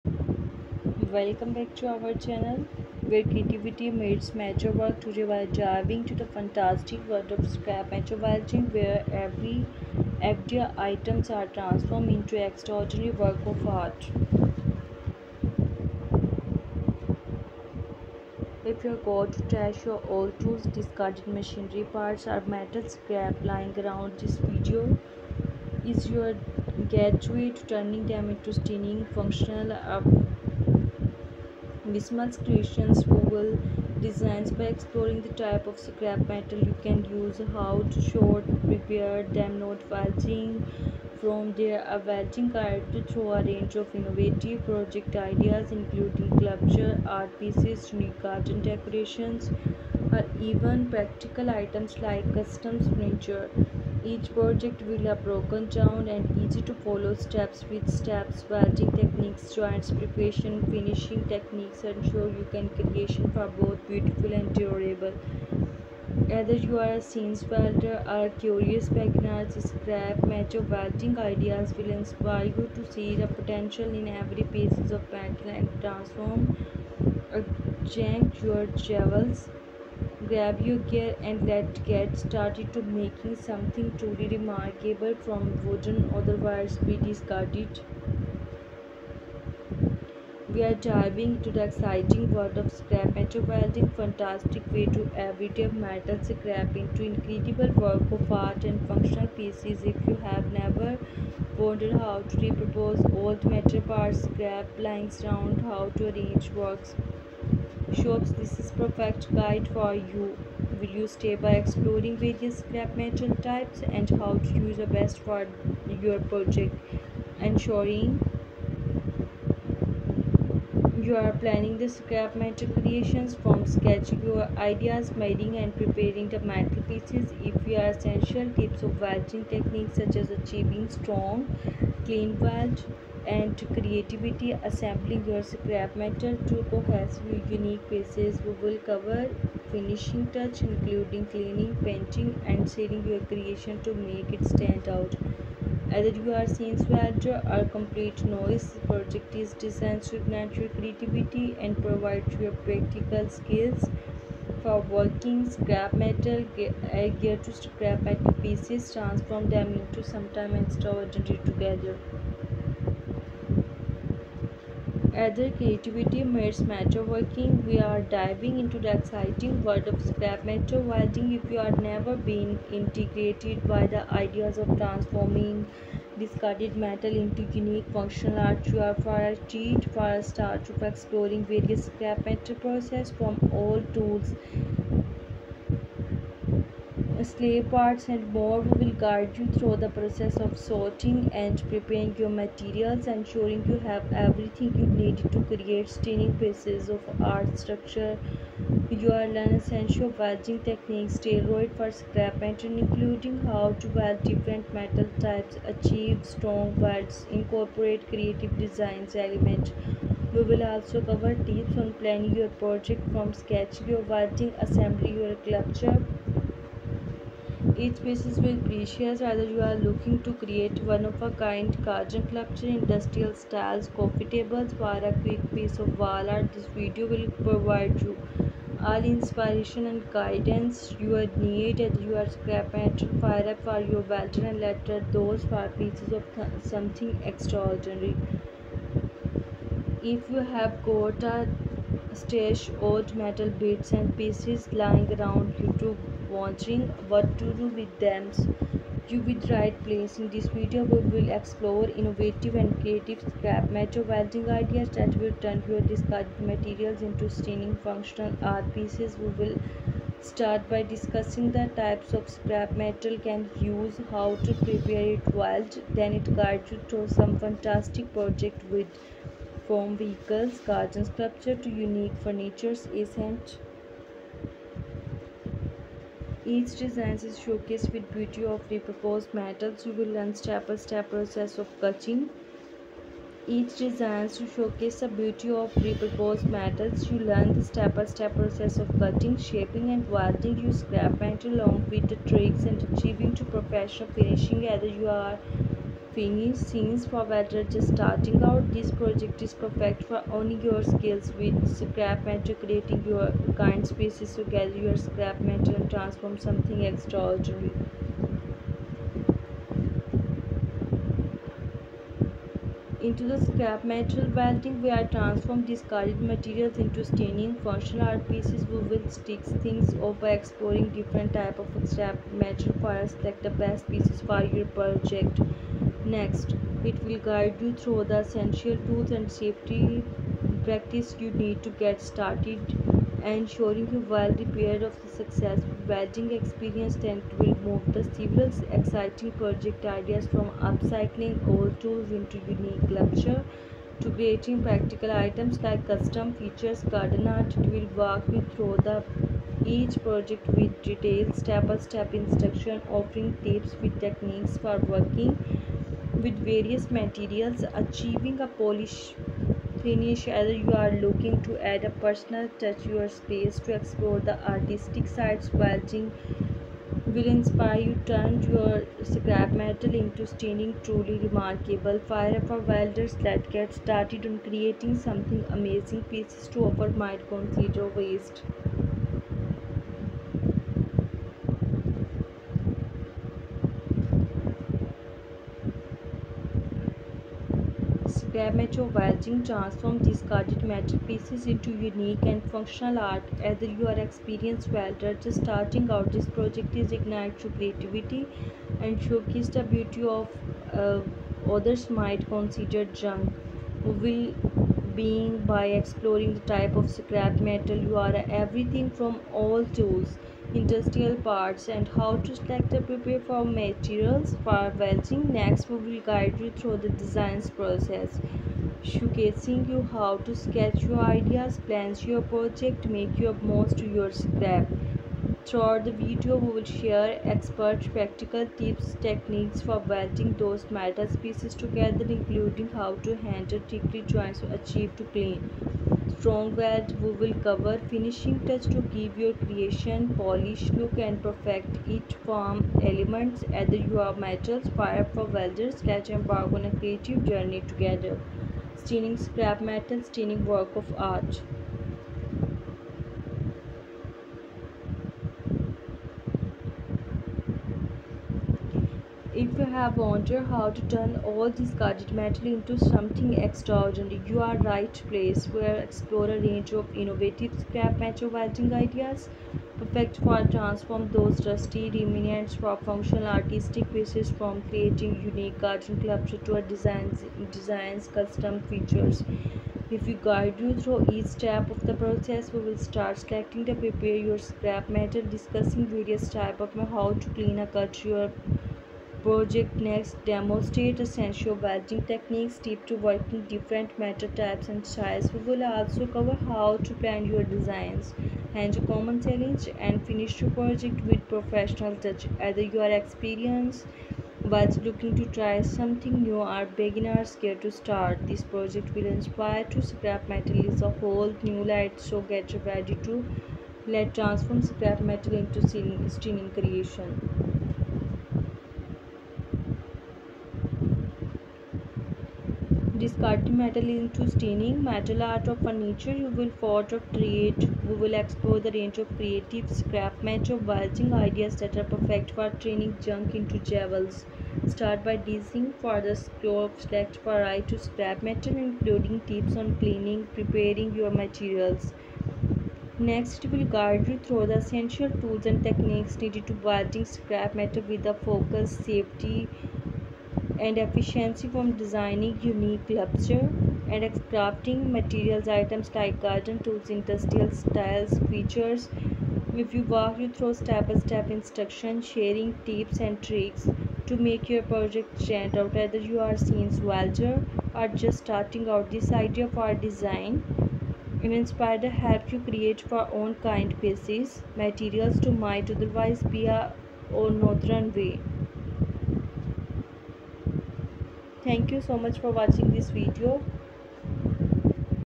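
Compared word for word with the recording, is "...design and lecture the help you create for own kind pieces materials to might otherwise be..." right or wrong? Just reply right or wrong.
wrong.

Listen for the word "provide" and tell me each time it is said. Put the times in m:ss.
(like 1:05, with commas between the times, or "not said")
2:31, 3:47.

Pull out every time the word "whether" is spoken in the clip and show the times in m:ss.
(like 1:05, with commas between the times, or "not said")
2:45, 3:39, 9:25.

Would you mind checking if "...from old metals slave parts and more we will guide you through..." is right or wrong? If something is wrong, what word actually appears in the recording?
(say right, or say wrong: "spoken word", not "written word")
wrong: "tools", not "metals".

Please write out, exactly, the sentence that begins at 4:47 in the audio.
You learn the step-by-step -step process of cutting, shaping and welding.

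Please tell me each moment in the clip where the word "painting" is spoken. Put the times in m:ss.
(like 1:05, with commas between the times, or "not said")
2:21.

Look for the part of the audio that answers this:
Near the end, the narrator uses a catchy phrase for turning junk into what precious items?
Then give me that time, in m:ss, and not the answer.
8:53.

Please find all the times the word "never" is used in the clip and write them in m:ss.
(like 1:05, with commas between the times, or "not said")
1:40, 2:51.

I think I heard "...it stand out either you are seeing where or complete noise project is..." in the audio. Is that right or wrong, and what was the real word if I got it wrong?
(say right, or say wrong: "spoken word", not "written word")
right.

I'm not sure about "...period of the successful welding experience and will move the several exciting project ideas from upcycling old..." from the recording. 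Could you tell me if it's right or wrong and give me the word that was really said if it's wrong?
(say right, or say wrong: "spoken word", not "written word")
right.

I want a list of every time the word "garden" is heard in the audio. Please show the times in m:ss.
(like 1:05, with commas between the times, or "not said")
0:48, 3:41, 4:30, 5:46, 7:55, 9:16.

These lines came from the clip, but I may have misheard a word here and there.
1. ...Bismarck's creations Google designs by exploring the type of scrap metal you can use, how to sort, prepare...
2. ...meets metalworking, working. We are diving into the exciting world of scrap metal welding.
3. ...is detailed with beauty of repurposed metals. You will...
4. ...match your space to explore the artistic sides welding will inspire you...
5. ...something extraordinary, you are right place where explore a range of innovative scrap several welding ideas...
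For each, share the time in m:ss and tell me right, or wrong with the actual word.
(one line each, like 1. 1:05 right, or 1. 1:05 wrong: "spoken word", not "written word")
1. 0:31 right
2. 2:46 right
3. 4:37 wrong: "showcased", not "detailed"
4. 6:02 wrong: "touch", not "match"
5. 7:42 wrong: "metal", not "several".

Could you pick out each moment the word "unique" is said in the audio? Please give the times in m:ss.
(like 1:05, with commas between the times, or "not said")
0:47, 2:17, 2:57, 4:31, 5:42, 6:31, 7:55, 9:12.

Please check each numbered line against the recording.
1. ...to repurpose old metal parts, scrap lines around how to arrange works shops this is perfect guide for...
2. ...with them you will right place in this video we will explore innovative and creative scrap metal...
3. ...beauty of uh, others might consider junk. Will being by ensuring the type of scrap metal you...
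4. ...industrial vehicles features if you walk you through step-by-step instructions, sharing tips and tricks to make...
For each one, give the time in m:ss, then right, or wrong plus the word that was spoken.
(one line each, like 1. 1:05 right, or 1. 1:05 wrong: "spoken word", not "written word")
1. 1:42 right
2. 4:07 right
3. 6:39 wrong: "exploring", not "ensuring"
4. 9:16 wrong: "styles", not "vehicles".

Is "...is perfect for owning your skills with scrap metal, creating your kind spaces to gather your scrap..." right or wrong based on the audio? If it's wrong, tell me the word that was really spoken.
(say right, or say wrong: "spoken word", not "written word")
right.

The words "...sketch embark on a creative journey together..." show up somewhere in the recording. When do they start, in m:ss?
7:25.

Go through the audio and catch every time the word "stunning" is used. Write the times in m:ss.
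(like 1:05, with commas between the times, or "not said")
0:28, 3:15, 4:17, 5:17, 6:10, 8:36.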